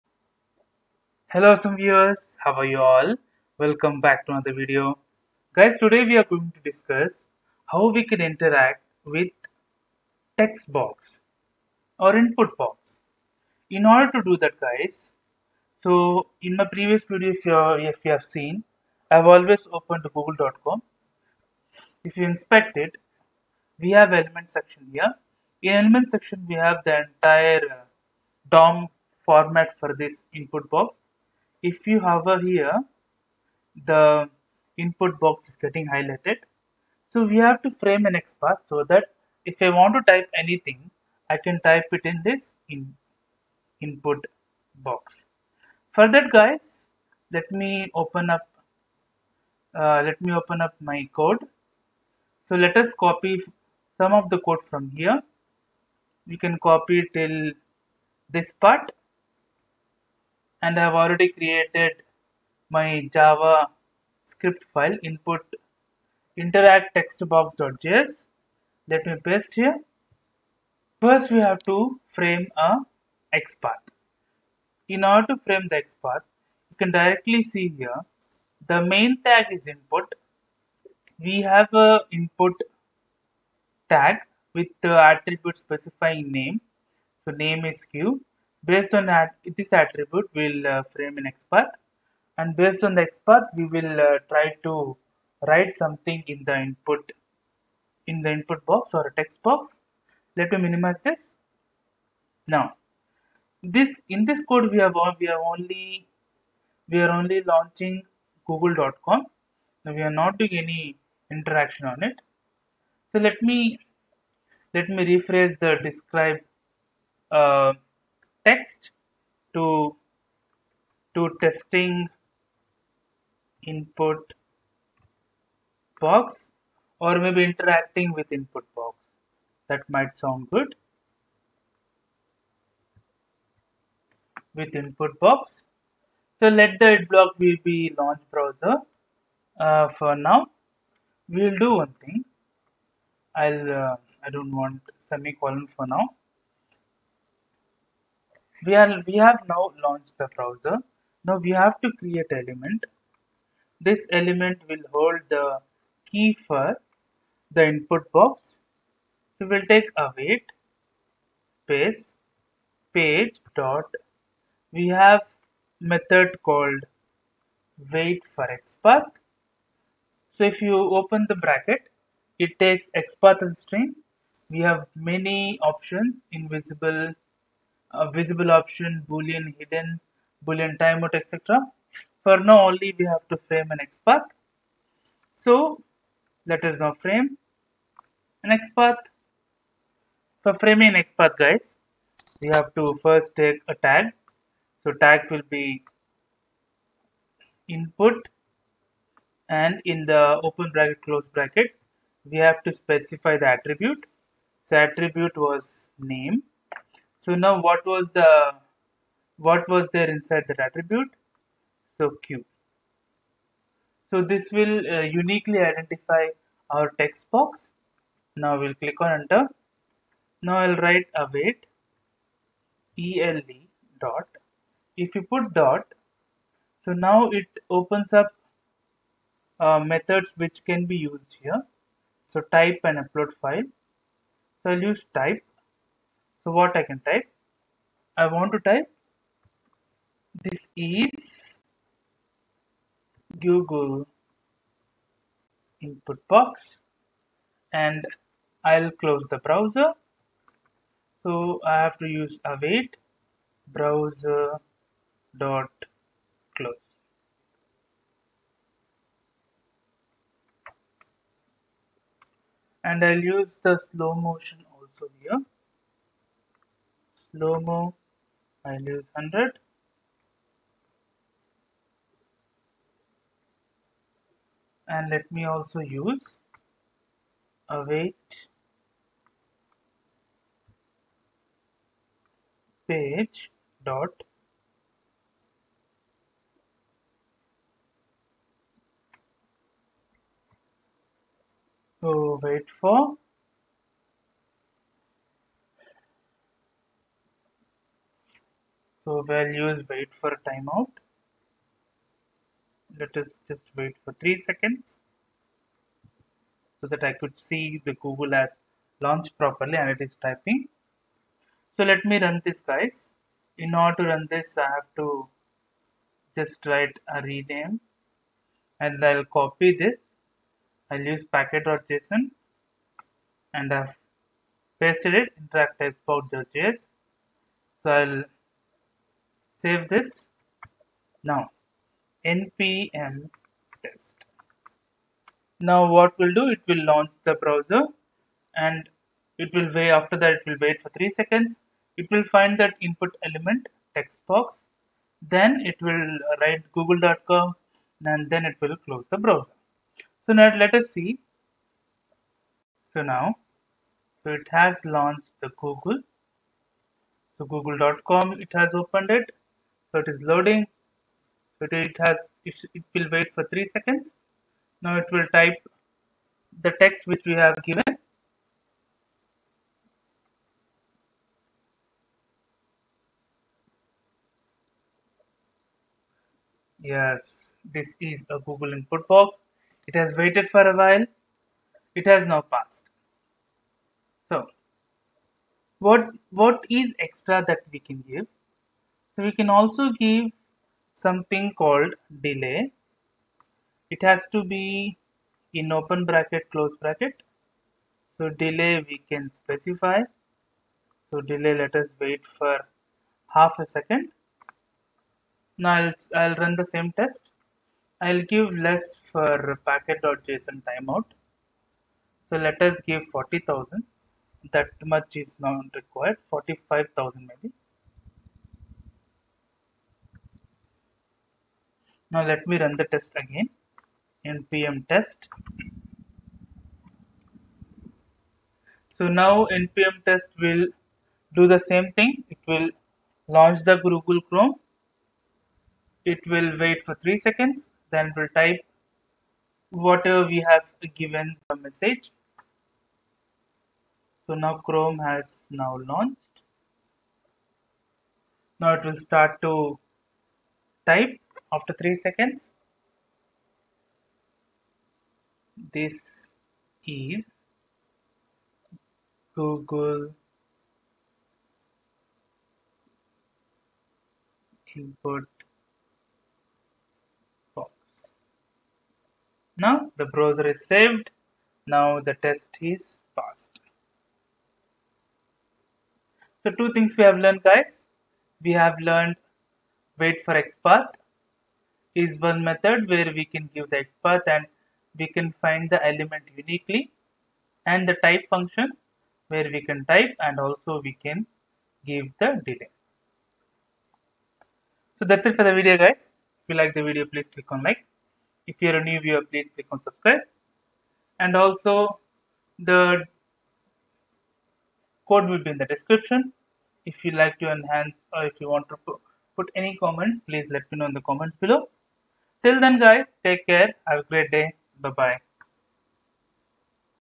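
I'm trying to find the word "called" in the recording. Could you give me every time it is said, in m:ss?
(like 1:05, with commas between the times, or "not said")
2:46, 6:31.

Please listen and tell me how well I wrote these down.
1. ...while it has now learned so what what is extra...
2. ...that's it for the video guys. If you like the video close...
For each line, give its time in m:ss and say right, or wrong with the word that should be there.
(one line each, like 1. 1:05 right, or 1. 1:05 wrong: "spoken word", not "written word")
1. 6:20 wrong: "passed", not "learned"
2. 8:15 wrong: "please", not "close".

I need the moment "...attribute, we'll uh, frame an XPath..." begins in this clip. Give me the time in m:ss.
1:29.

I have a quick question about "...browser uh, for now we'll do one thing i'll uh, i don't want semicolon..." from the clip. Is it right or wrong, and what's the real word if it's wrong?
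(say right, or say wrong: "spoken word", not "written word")
right.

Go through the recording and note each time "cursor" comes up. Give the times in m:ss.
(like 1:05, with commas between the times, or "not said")
not said.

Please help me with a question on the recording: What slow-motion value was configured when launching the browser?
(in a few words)
100.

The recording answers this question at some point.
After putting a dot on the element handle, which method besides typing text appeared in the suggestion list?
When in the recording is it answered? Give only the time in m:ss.
3:52.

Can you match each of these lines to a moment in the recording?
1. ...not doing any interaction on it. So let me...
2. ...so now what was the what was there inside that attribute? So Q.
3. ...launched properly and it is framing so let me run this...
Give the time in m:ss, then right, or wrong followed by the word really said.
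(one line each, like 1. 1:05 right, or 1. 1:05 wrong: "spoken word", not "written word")
1. 1:50 right
2. 3:27 right
3. 5:08 wrong: "typing", not "framing".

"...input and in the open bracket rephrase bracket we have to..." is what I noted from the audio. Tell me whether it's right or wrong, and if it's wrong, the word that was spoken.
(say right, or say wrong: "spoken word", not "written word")
wrong: "close", not "rephrase".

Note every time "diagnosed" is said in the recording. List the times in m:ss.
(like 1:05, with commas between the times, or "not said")
not said.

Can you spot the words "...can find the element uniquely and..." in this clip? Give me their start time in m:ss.
8:05.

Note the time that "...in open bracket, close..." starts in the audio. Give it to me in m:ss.
6:35.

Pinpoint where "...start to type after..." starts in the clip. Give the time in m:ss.
7:29.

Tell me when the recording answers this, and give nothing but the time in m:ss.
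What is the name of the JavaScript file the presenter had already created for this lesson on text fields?
1:05.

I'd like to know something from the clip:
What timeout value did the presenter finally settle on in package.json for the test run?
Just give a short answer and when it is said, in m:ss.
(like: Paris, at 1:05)
45,000, at 6:56.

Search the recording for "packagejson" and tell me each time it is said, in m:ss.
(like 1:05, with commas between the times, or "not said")
5:21, 6:49.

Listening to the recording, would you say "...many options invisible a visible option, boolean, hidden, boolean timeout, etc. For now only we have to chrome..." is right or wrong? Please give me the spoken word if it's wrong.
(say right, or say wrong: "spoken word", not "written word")
wrong: "frame", not "chrome".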